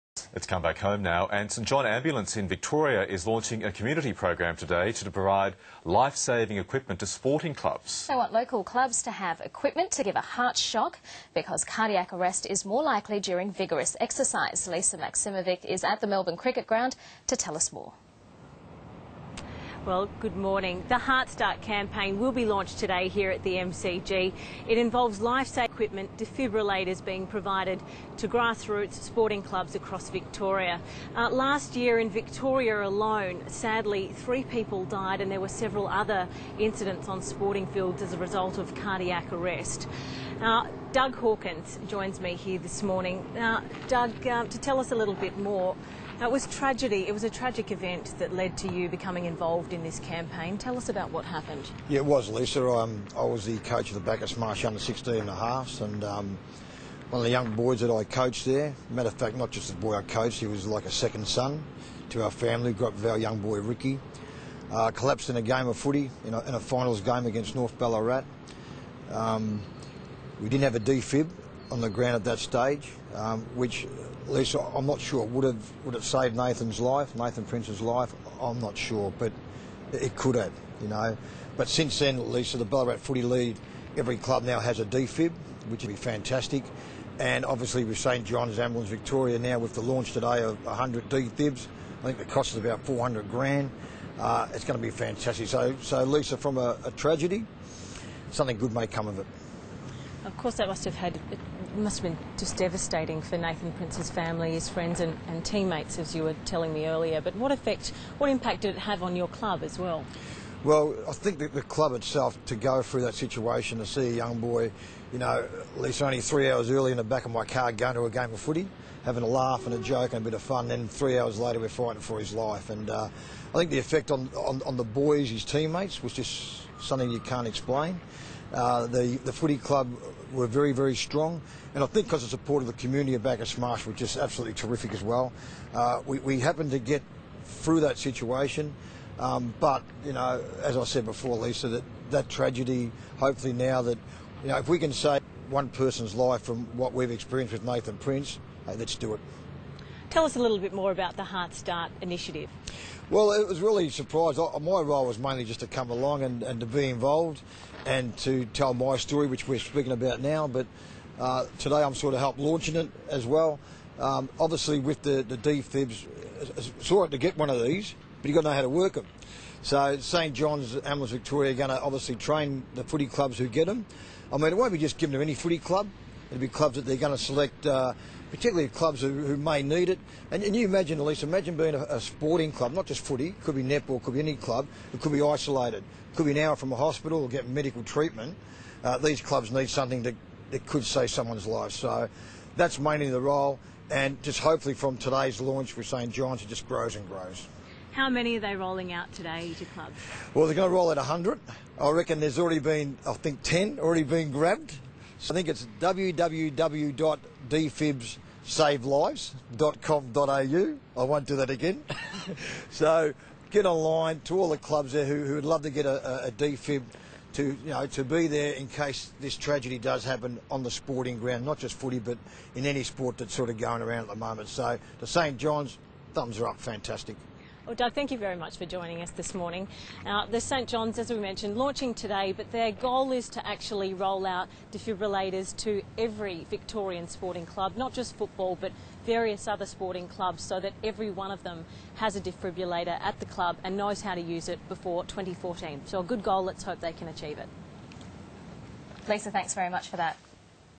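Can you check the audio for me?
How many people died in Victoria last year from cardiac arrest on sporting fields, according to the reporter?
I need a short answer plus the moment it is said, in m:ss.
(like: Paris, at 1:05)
3, at 0:34.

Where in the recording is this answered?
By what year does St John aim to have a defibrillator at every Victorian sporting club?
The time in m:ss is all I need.
4:05.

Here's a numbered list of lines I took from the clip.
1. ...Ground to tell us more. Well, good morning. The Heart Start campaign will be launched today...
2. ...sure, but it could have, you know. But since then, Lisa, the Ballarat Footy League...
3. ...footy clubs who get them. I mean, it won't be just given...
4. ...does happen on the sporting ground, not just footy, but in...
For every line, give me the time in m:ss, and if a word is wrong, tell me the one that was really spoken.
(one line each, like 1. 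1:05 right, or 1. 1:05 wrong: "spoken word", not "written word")
1. 0:16 right
2. 1:18 right
3. 2:52 right
4. 3:39 right.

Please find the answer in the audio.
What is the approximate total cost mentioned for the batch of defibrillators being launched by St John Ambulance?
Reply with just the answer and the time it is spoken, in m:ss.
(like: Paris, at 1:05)
$400,000, at 1:32.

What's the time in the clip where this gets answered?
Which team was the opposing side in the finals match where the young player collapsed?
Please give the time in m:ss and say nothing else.
1:07.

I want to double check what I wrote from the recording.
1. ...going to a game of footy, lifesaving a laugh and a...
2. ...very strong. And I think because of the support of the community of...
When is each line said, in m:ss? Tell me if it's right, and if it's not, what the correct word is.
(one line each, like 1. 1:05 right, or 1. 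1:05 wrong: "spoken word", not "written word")
1. 1:57 wrong: "having", not "lifesaving"
2. 2:10 right.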